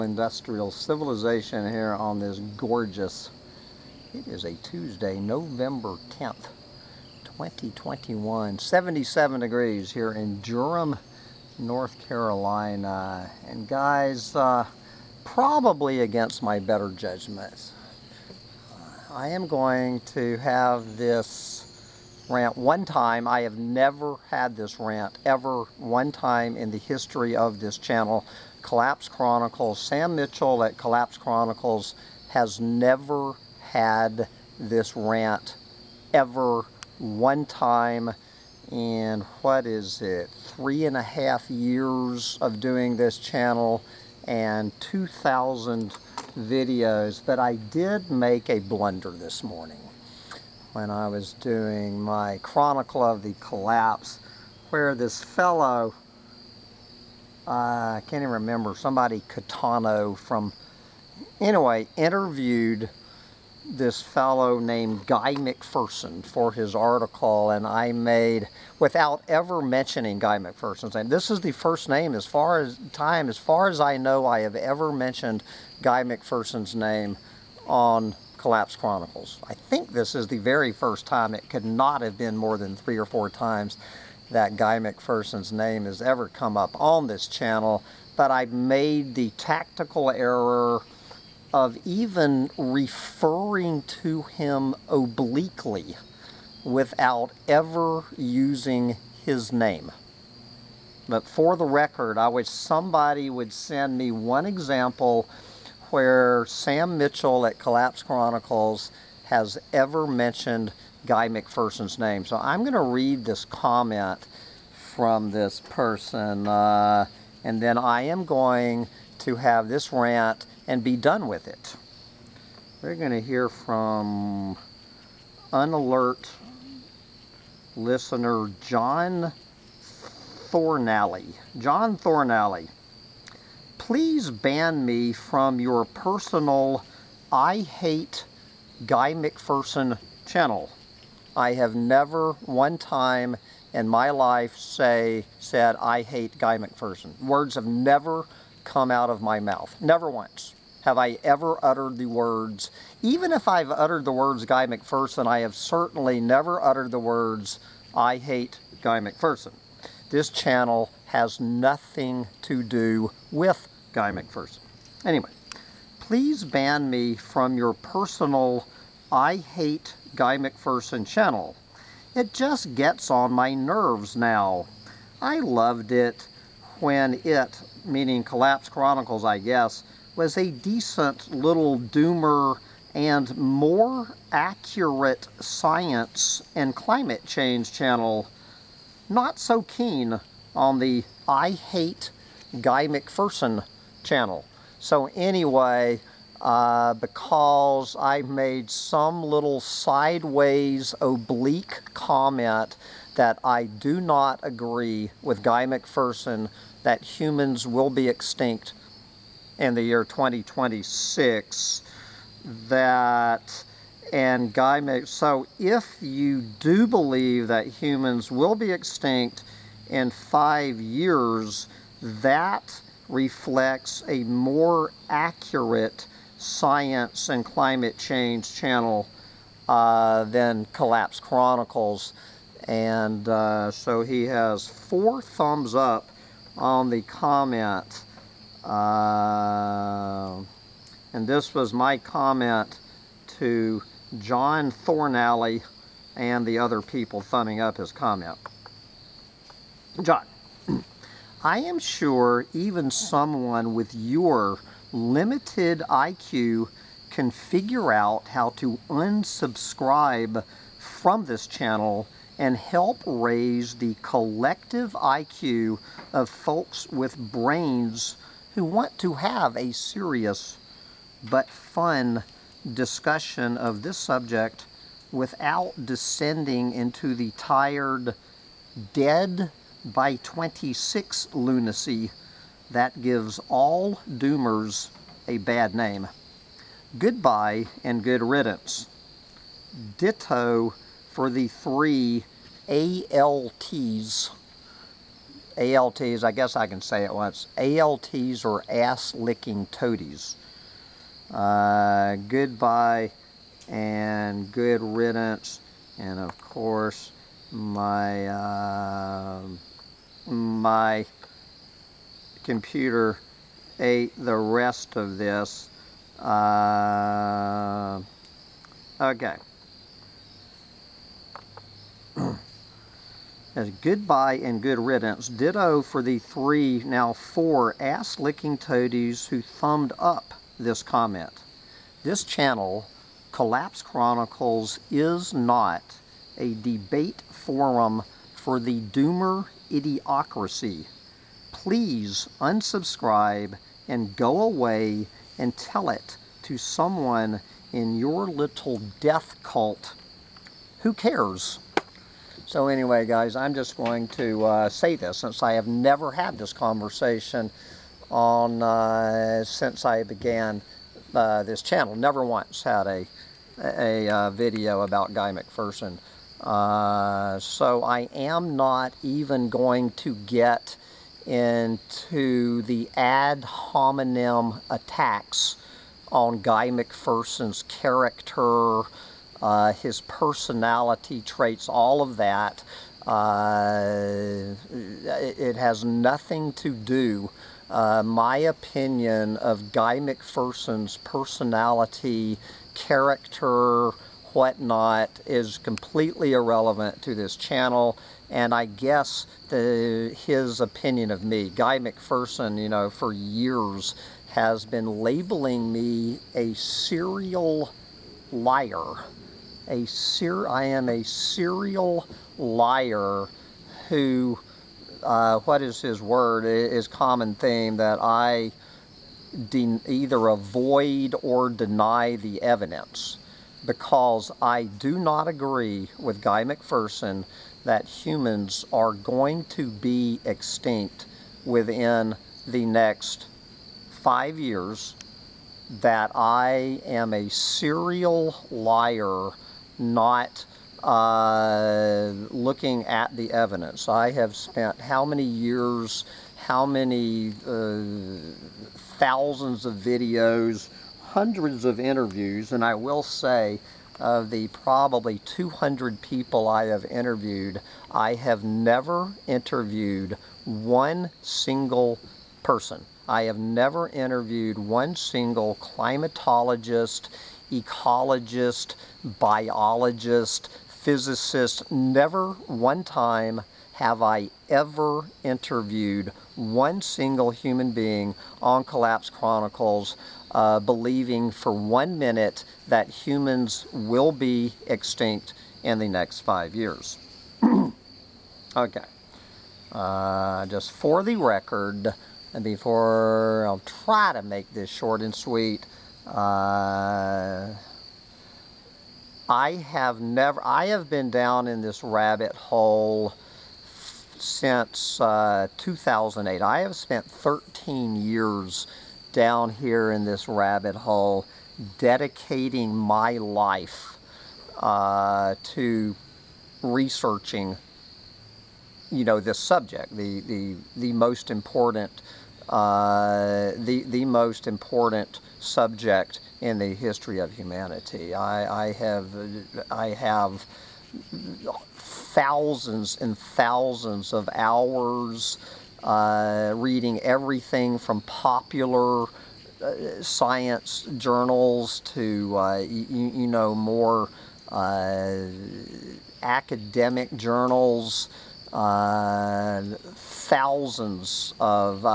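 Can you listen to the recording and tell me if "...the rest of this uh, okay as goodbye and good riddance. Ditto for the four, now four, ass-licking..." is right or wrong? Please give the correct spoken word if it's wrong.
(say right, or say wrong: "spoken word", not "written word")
wrong: "three", not "four".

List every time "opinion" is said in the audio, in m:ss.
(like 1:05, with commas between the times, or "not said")
6:28, 6:40.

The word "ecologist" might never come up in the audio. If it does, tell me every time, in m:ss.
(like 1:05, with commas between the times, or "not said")
7:47.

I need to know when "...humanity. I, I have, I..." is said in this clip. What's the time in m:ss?
8:47.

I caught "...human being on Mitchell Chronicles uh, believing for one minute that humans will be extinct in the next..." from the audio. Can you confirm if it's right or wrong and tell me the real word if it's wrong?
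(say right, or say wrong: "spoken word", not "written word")
wrong: "Collapse", not "Mitchell".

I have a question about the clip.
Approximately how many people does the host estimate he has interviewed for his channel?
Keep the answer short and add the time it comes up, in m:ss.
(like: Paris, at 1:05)
200, at 7:35.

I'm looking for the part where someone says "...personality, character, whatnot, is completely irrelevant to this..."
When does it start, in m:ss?
6:30.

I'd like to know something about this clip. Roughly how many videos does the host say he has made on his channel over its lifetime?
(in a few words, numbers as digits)
2,000.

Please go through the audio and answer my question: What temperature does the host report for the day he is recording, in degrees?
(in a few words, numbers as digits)
77.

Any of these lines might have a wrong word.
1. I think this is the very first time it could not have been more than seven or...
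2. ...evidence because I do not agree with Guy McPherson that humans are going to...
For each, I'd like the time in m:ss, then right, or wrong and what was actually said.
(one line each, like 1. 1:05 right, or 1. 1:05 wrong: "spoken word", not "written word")
1. 1:19 wrong: "three", not "seven"
2. 7:02 right.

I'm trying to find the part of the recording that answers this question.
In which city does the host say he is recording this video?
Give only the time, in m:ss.
0:10.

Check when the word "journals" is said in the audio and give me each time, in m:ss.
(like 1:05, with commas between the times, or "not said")
9:00, 9:07.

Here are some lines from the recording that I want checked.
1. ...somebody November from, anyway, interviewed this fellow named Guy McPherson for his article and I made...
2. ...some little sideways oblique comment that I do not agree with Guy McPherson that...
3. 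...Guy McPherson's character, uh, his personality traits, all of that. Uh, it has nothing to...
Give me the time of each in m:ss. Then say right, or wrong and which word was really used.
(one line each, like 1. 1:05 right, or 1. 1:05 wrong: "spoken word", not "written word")
1. 0:58 wrong: "Catano", not "November"
2. 3:18 right
3. 6:16 right.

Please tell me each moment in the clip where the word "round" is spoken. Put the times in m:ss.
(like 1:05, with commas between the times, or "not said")
not said.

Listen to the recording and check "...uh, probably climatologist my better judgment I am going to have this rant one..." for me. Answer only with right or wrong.
wrong.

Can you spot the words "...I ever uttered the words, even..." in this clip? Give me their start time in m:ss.
2:30.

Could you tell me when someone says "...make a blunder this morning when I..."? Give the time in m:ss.
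0:48.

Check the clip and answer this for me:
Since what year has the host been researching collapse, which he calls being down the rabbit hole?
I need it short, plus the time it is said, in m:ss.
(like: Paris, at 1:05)
2008, at 8:25.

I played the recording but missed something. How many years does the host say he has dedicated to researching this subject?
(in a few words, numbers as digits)
13.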